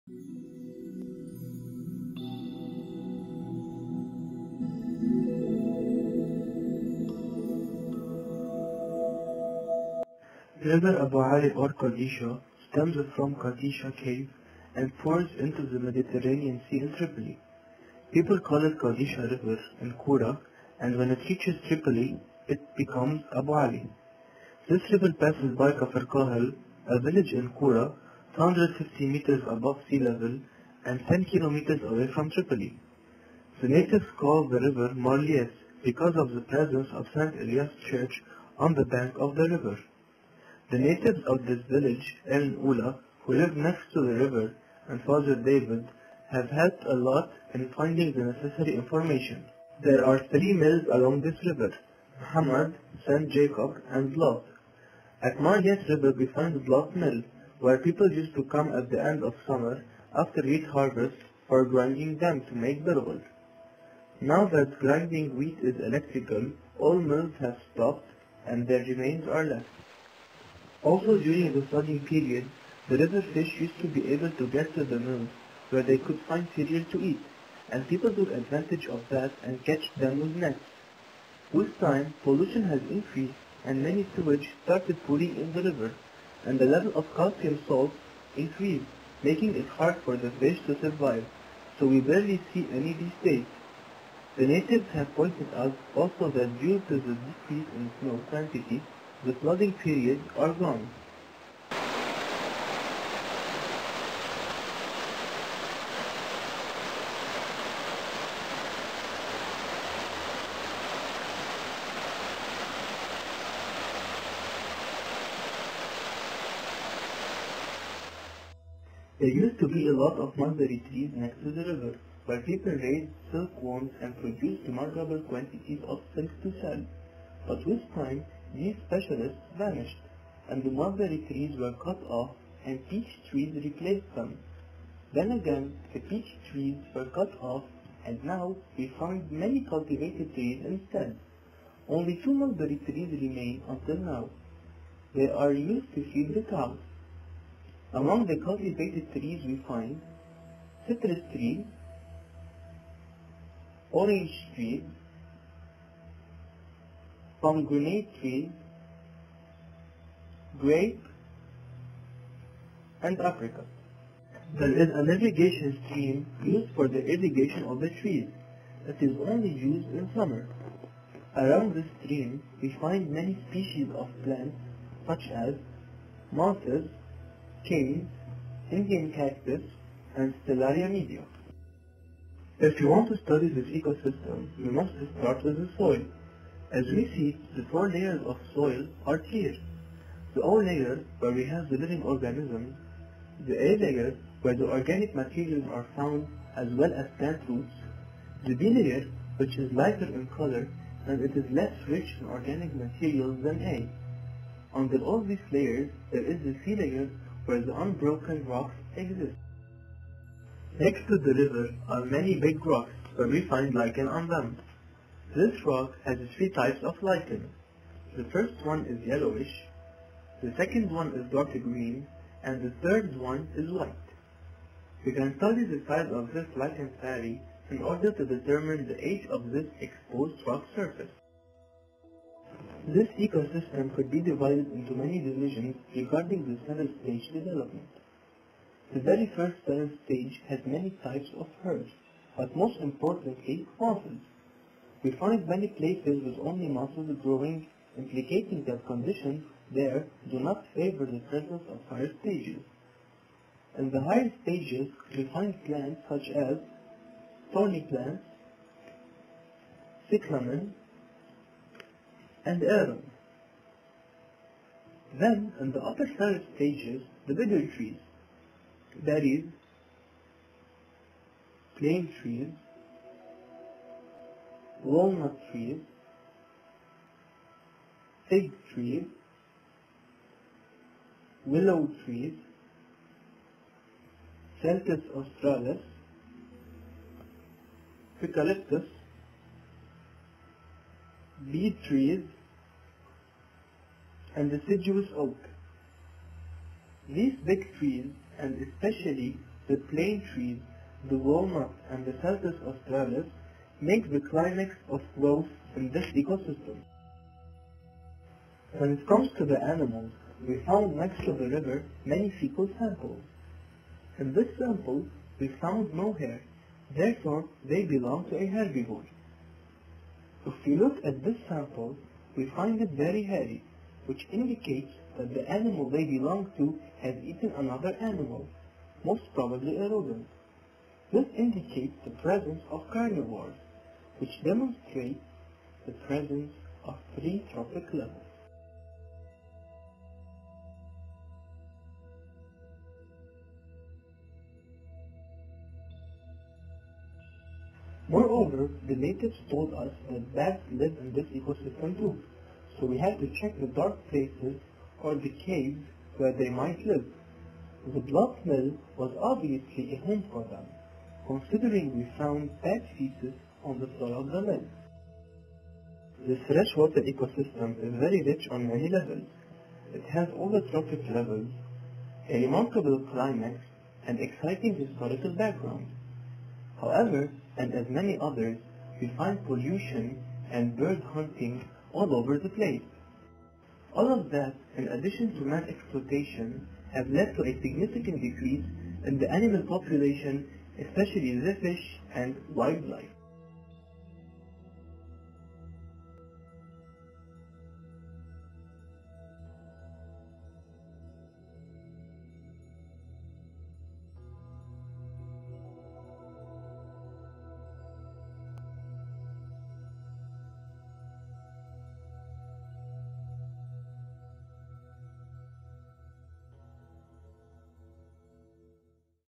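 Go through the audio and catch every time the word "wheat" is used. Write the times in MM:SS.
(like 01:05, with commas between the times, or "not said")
01:00, 01:05.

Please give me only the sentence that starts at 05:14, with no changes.
In this sample, we found no hair, therefore they belong to a herbivore.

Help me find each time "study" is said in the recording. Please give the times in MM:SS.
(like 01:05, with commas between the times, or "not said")
03:03, 03:45.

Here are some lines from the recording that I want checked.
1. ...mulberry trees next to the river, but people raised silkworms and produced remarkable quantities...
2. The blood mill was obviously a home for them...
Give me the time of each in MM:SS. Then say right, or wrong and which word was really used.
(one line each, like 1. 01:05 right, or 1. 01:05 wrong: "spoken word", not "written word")
1. 02:00 right
2. 05:57 right.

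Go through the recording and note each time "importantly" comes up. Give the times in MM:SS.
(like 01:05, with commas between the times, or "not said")
04:02.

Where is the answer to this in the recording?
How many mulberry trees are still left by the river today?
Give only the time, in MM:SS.
02:22.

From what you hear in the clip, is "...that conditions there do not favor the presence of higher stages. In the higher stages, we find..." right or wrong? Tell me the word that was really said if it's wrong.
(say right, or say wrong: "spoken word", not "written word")
right.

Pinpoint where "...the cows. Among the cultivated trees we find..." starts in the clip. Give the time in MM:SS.
02:26.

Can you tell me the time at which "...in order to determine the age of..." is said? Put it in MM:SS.
03:47.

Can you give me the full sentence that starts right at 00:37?
Elias Church on the bank of the river.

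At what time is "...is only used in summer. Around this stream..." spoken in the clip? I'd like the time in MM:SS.
02:49.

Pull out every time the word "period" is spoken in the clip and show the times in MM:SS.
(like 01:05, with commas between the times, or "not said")
01:12, 01:39.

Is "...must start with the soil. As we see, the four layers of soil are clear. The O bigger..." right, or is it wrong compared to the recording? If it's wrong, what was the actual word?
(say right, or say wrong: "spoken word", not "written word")
wrong: "layer", not "bigger".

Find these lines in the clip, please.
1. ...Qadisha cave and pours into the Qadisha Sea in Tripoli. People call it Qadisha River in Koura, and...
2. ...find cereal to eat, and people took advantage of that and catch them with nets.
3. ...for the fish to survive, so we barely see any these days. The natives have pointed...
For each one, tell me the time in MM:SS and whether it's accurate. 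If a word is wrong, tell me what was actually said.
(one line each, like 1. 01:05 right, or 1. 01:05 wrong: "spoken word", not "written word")
1. 00:13 wrong: "Mediterranean", not "Qadisha"
2. 01:16 right
3. 01:30 right.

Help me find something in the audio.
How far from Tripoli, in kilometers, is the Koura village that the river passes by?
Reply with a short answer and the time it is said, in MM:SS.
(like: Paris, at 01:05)
10, at 00:31.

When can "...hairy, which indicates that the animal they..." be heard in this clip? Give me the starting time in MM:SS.
05:23.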